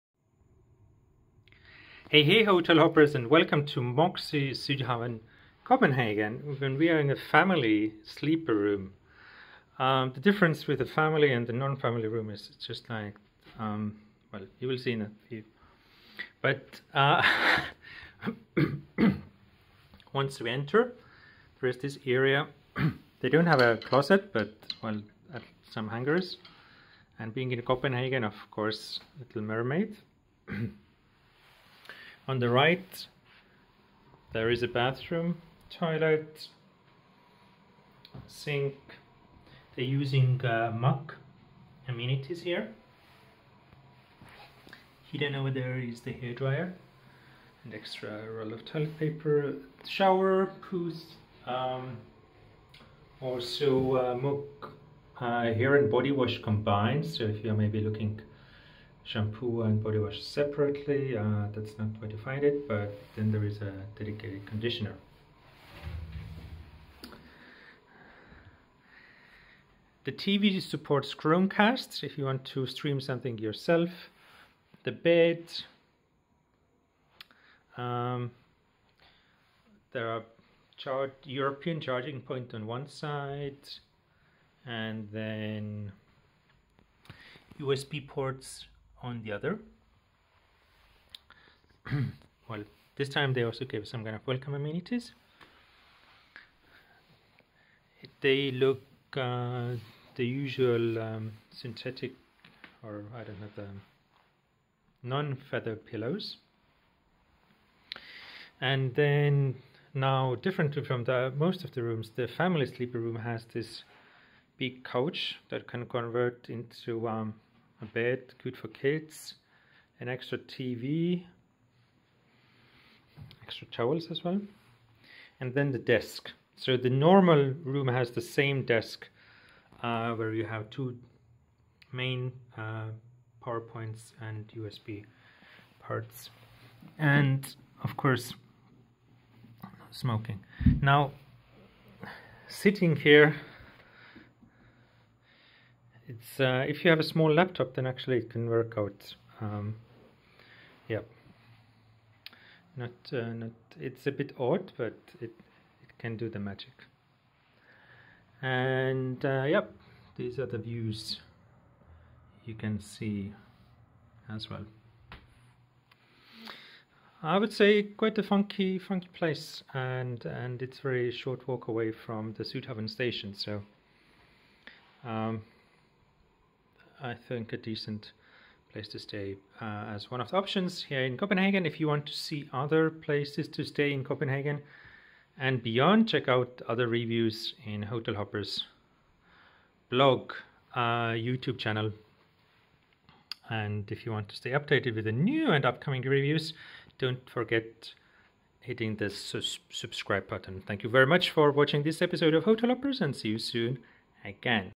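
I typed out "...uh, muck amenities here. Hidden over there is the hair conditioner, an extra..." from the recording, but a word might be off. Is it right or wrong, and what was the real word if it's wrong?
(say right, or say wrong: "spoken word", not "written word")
wrong: "dryer", not "conditioner".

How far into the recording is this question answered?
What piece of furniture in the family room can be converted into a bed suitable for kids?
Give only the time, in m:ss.
1:54.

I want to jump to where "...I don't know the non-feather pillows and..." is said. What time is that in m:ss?
1:43.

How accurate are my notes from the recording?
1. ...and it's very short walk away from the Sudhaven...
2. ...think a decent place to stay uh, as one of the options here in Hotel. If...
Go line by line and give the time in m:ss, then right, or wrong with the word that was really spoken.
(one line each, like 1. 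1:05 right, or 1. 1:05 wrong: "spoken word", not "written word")
1. 2:50 right
2. 2:57 wrong: "Copenhagen", not "Hotel".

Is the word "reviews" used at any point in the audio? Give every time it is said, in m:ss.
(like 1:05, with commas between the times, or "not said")
3:06, 3:16.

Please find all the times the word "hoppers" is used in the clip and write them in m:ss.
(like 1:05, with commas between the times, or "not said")
0:02, 3:08, 3:22.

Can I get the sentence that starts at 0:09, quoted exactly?
Um, the difference with the family and the non-family room is just like, um, well, you will see in a few.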